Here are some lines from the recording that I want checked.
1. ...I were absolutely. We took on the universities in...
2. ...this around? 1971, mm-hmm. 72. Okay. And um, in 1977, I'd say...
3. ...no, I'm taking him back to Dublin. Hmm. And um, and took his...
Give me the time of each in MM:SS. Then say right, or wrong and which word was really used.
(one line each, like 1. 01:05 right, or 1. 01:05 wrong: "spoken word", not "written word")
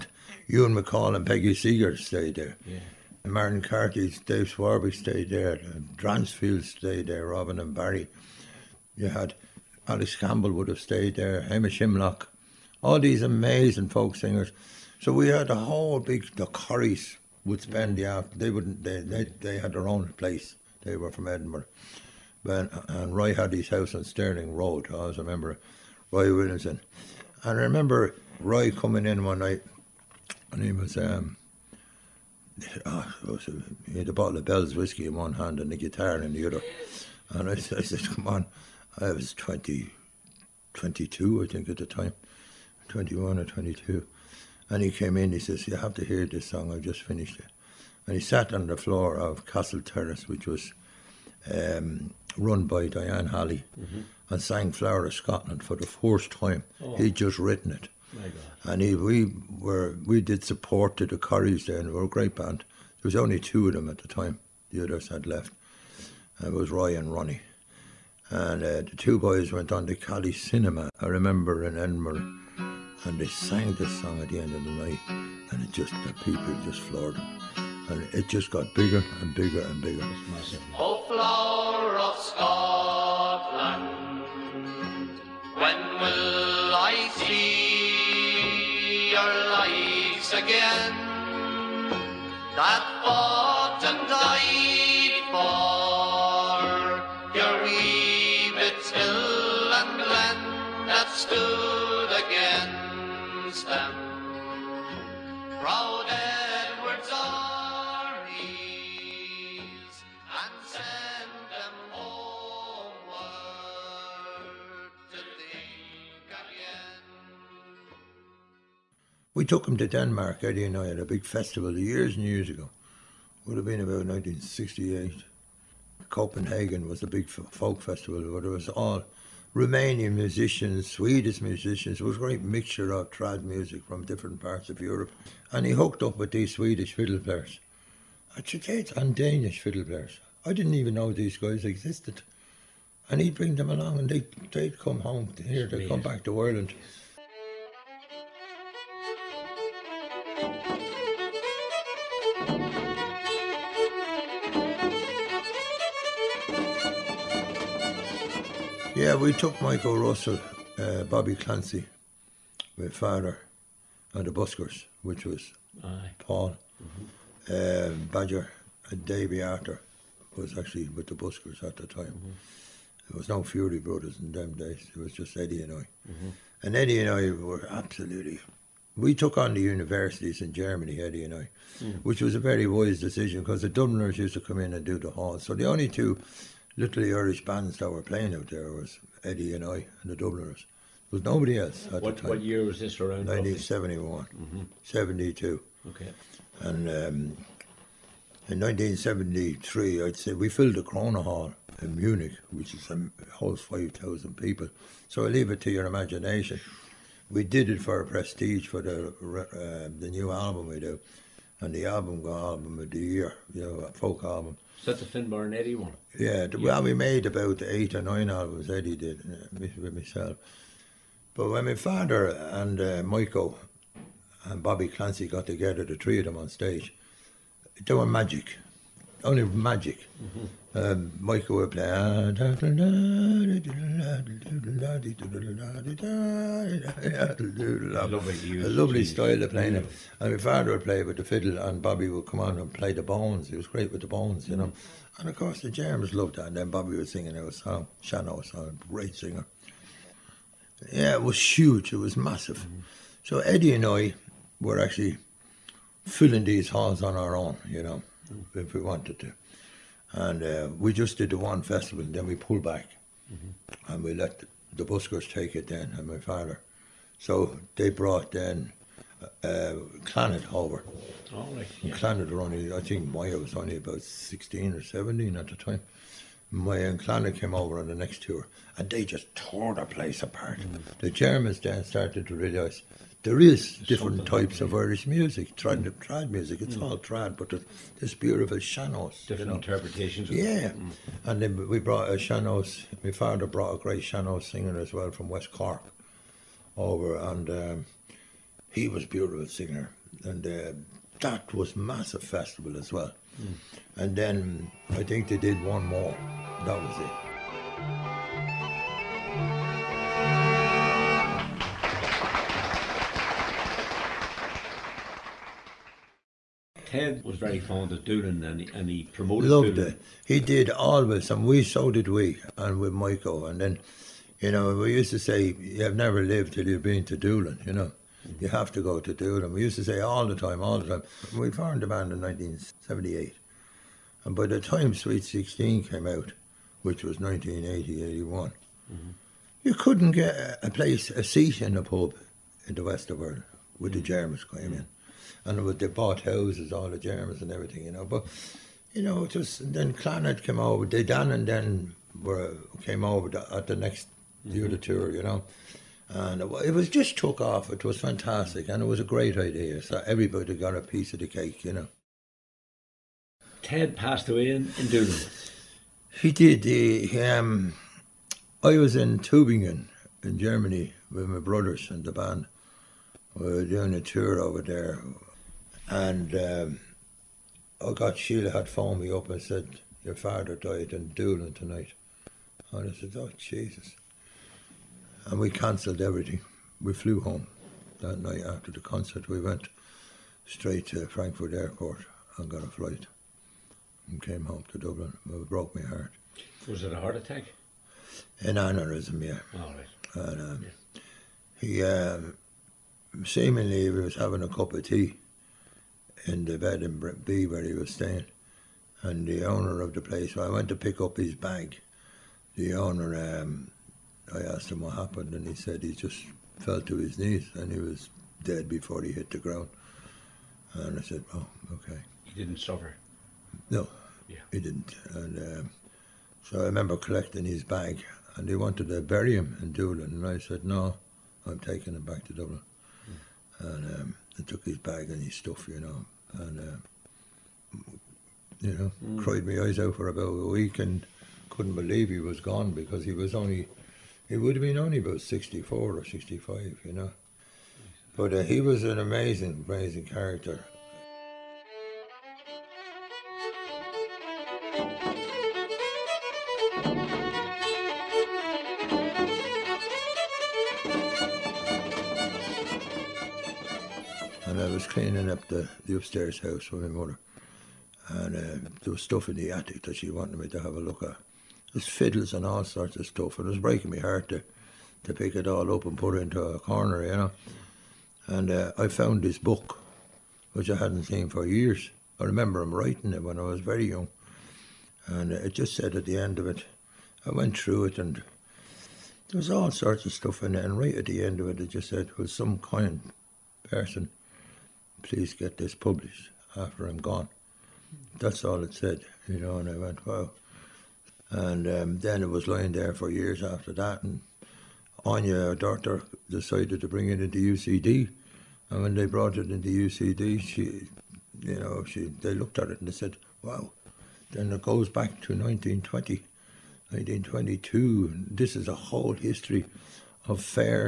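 1. 02:57 right
2. 03:12 wrong: "1973", not "1977"
3. 07:10 right.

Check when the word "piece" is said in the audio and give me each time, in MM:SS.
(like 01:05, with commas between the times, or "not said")
06:00.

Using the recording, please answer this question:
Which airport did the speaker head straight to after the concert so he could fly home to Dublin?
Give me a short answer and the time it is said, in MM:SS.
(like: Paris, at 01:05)
Frankfurt Airport, at 06:31.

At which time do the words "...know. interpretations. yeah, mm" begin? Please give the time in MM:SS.
04:49.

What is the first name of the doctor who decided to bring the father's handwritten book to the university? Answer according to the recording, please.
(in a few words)
Anya.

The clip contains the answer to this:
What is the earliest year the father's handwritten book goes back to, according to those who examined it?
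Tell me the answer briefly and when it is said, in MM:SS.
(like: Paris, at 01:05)
1920, at 08:35.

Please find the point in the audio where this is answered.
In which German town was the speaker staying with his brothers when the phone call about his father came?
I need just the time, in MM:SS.
06:09.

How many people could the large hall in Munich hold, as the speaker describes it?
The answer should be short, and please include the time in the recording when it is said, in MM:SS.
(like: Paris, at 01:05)
5,000, at 03:23.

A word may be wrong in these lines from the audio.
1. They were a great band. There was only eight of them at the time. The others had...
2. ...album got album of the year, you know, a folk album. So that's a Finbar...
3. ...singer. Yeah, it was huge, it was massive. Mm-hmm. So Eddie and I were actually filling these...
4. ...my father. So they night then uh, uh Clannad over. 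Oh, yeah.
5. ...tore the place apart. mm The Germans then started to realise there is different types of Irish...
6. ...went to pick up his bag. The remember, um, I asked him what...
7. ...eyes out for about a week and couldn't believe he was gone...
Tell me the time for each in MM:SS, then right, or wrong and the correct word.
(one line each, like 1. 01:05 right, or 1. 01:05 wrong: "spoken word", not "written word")
1. 01:01 wrong: "two", not "eight"
2. 03:31 right
3. 04:09 right
4. 04:26 wrong: "brought", not "night"
5. 04:39 right
6. 06:50 wrong: "owner", not "remember"
7. 07:19 right.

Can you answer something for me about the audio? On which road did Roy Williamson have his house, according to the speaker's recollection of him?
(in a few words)
Sterling Road.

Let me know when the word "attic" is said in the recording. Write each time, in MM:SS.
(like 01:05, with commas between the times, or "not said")
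07:49.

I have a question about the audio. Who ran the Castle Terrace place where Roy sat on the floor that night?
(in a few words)
Diane Halley.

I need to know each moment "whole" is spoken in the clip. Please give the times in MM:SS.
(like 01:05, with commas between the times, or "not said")
00:15, 08:38.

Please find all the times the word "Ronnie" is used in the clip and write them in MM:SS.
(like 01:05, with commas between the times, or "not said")
01:07.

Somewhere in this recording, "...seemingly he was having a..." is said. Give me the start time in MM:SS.
06:43.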